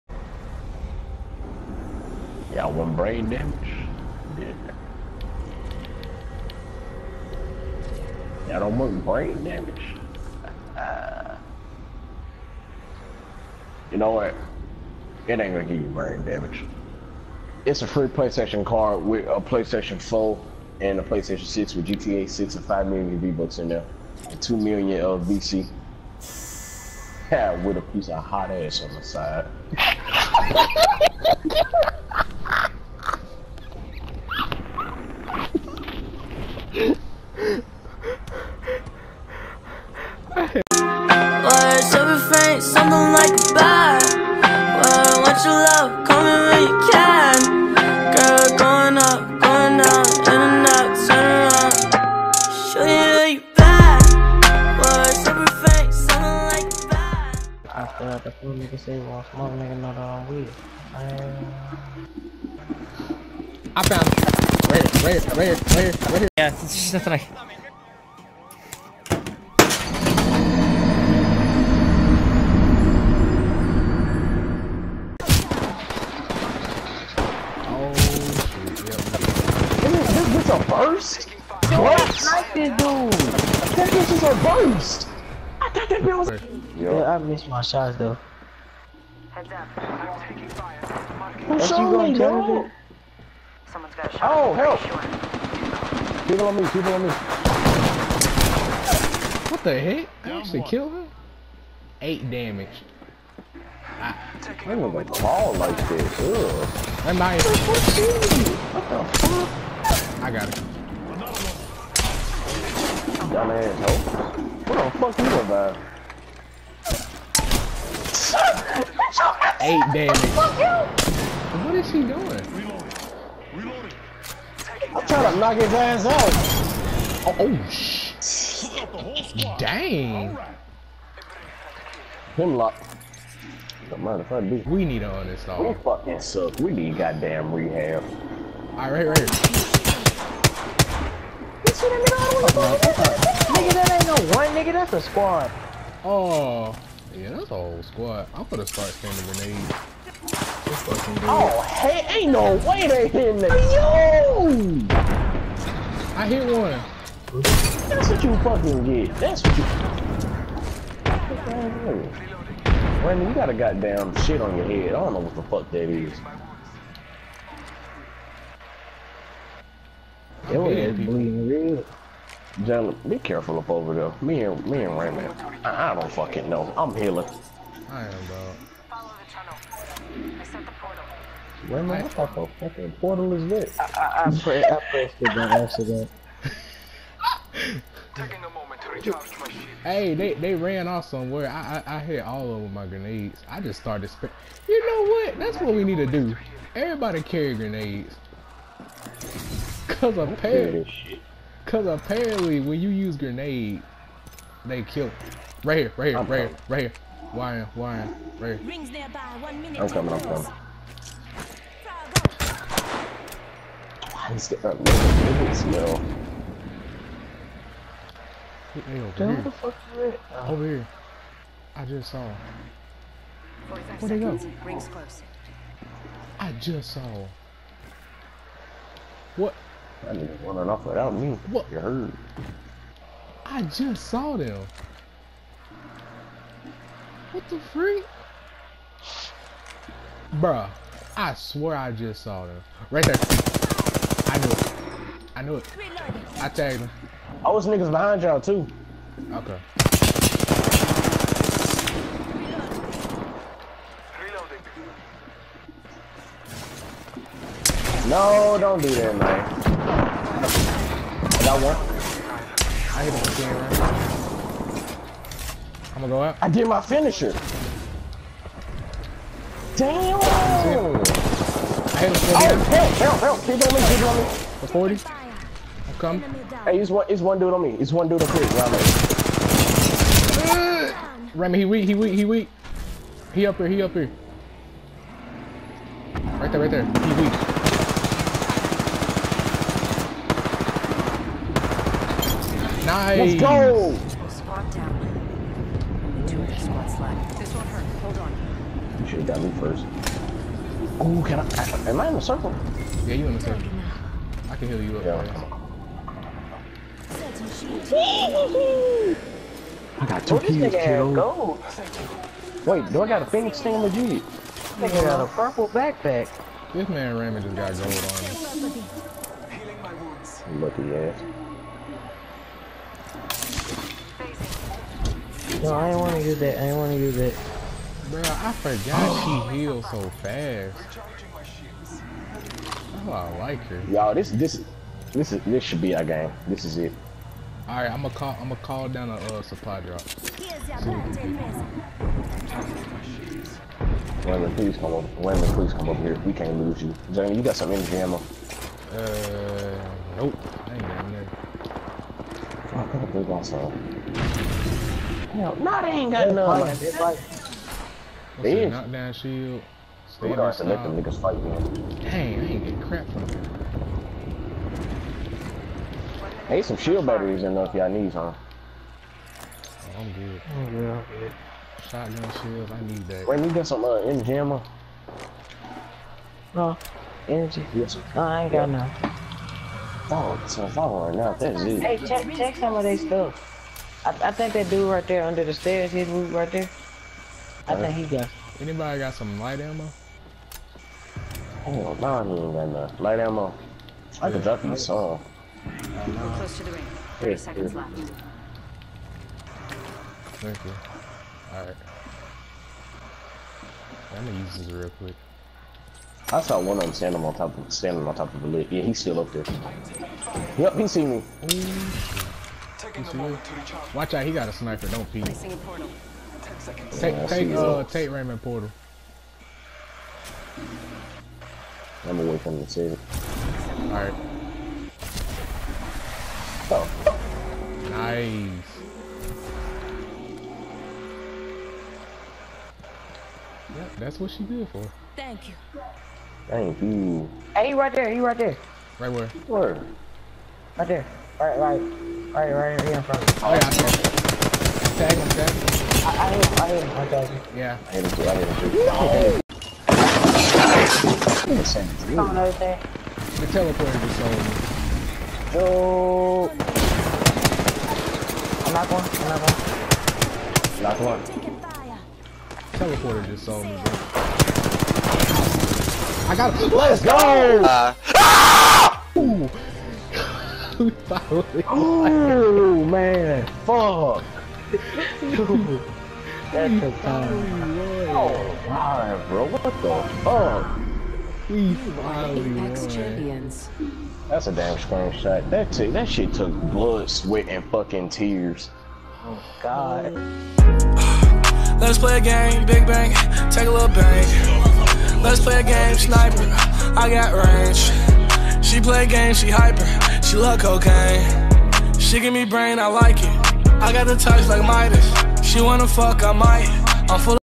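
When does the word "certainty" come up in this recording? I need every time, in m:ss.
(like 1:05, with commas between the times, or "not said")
not said.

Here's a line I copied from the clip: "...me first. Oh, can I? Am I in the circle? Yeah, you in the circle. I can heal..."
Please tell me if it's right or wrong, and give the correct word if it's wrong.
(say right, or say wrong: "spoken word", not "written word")
right.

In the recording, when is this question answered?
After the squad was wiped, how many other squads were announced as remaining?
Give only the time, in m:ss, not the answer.
4:56.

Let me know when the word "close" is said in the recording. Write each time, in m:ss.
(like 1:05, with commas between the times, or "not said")
3:44, 6:36.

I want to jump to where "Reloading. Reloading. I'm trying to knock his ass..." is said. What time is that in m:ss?
2:02.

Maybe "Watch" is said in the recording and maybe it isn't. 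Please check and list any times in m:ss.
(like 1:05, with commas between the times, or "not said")
6:53.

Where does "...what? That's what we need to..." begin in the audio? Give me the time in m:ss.
3:15.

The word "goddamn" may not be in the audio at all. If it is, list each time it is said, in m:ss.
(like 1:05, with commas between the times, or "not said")
2:16, 2:43.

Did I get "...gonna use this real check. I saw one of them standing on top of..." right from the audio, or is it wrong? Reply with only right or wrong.
wrong.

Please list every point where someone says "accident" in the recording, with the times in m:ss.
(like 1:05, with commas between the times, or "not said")
3:05.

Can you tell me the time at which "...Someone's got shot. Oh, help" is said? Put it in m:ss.
1:33.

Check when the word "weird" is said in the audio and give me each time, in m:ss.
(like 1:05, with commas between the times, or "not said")
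1:00.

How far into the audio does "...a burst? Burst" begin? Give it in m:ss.
1:20.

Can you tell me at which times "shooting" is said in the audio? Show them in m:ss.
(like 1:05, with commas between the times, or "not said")
not said.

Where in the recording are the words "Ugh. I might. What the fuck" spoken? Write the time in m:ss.
1:46.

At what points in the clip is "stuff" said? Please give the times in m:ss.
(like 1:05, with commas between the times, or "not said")
6:22.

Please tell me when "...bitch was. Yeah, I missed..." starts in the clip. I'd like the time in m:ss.
1:26.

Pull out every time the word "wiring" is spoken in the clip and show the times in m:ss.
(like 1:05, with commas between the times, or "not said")
not said.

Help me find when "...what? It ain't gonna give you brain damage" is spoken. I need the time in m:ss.
0:14.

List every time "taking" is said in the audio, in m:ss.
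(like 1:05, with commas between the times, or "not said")
1:30, 3:08.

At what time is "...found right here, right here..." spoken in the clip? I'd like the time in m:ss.
1:03.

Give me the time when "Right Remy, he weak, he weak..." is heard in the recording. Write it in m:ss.
4:40.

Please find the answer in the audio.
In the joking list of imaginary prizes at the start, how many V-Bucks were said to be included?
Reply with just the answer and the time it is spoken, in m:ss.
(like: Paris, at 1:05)
5 million, at 0:22.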